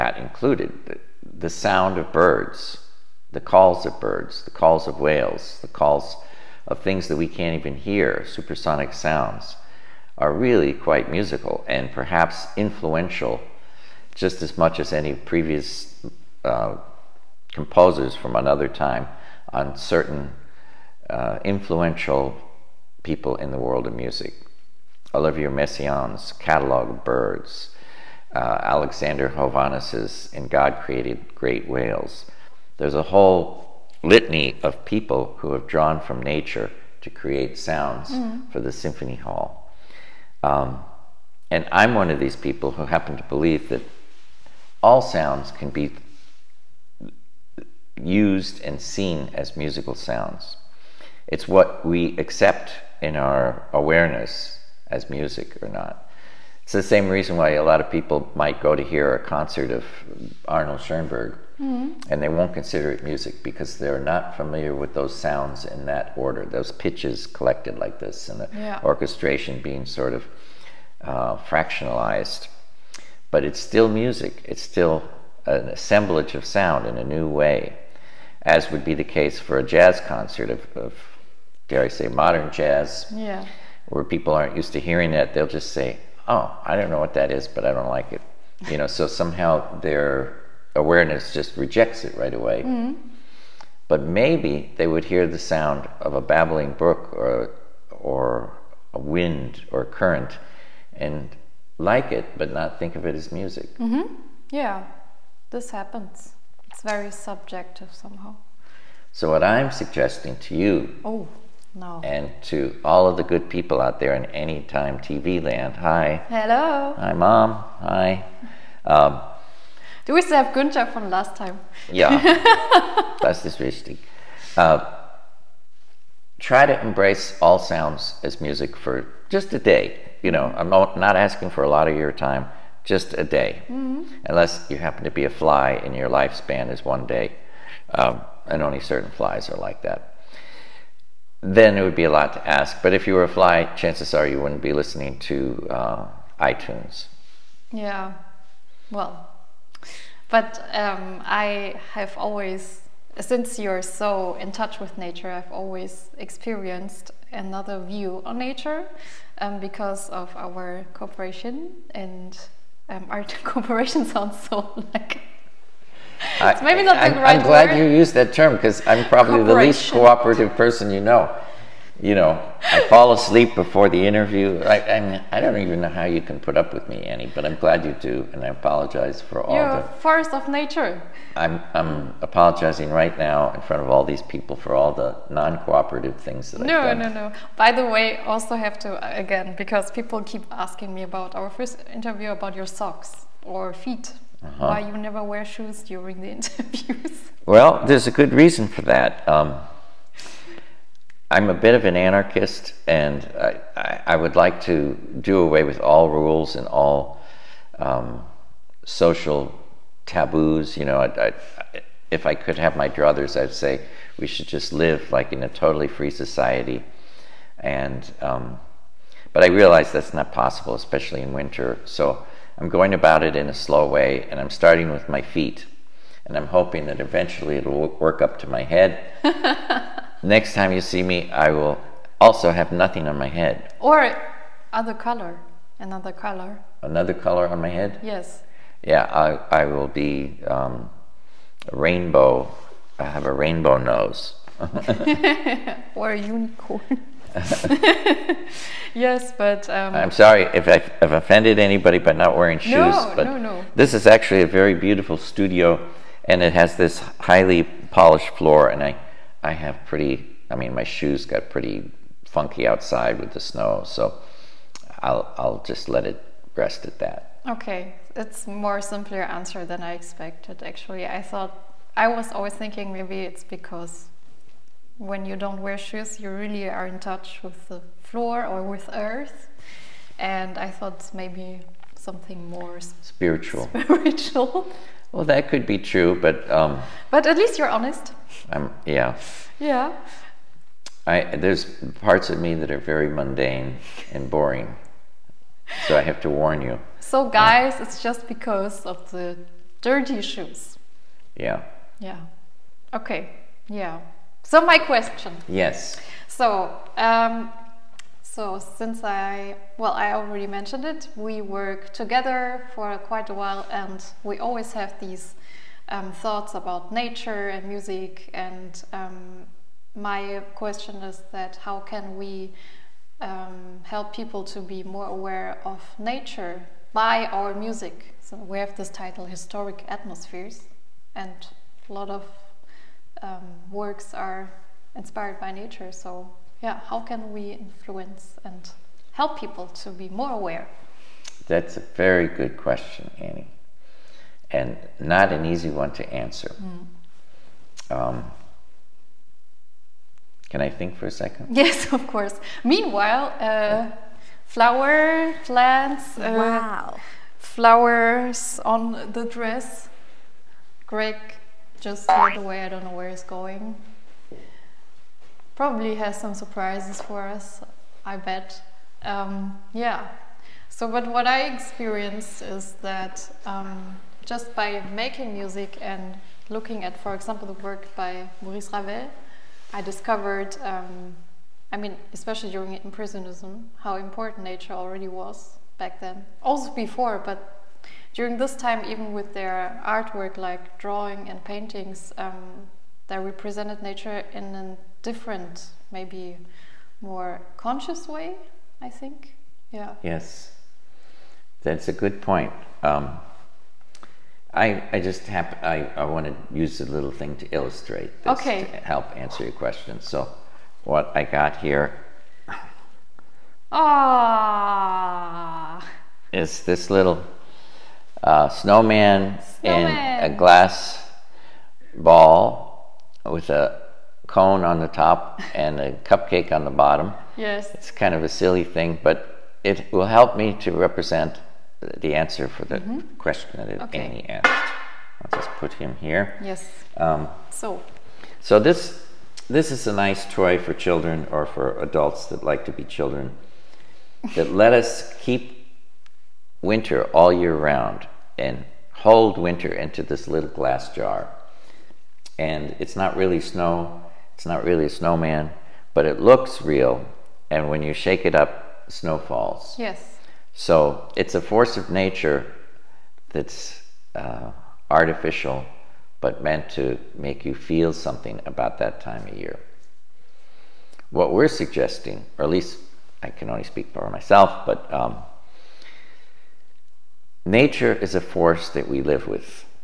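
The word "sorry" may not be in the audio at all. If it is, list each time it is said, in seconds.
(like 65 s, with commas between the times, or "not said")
250 s.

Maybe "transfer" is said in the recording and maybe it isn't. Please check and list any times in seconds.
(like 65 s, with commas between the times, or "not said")
not said.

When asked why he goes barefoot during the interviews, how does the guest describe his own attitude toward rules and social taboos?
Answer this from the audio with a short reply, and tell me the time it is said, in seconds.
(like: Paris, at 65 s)
anarchist, at 201 s.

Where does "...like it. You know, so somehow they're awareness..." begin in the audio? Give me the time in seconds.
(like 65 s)
87 s.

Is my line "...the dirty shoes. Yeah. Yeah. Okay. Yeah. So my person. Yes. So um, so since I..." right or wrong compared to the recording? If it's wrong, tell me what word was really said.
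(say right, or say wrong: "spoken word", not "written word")
wrong: "question", not "person".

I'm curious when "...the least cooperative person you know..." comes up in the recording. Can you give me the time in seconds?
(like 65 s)
169 s.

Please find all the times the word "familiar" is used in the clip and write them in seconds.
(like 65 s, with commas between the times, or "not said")
64 s.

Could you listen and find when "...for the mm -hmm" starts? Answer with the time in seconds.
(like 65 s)
432 s.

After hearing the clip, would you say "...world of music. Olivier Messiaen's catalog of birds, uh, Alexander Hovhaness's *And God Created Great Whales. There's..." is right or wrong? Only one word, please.
right.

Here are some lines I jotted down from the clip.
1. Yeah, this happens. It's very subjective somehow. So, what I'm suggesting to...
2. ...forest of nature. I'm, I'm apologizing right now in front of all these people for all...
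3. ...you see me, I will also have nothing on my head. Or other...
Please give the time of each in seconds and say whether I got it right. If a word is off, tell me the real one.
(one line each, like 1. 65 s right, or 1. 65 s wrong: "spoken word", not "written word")
1. 104 s right
2. 179 s right
3. 230 s right.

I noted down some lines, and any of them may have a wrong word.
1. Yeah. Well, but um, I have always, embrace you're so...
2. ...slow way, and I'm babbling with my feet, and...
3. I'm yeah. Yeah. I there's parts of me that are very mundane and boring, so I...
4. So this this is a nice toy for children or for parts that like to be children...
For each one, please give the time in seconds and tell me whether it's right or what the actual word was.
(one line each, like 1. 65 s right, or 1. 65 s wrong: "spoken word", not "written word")
1. 147 s wrong: "since", not "embrace"
2. 223 s wrong: "starting", not "babbling"
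3. 288 s right
4. 438 s wrong: "adults", not "parts".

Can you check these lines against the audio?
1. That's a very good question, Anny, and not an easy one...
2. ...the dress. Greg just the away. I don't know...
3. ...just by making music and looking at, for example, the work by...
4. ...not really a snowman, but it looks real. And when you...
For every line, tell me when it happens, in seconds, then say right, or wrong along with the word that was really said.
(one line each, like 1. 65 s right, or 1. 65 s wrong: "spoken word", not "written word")
1. 341 s right
2. 359 s right
3. 374 s right
4. 454 s right.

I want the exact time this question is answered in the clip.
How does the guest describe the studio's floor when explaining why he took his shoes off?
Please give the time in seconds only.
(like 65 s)
257 s.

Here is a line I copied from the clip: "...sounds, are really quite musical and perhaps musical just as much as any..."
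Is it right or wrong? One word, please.
wrong.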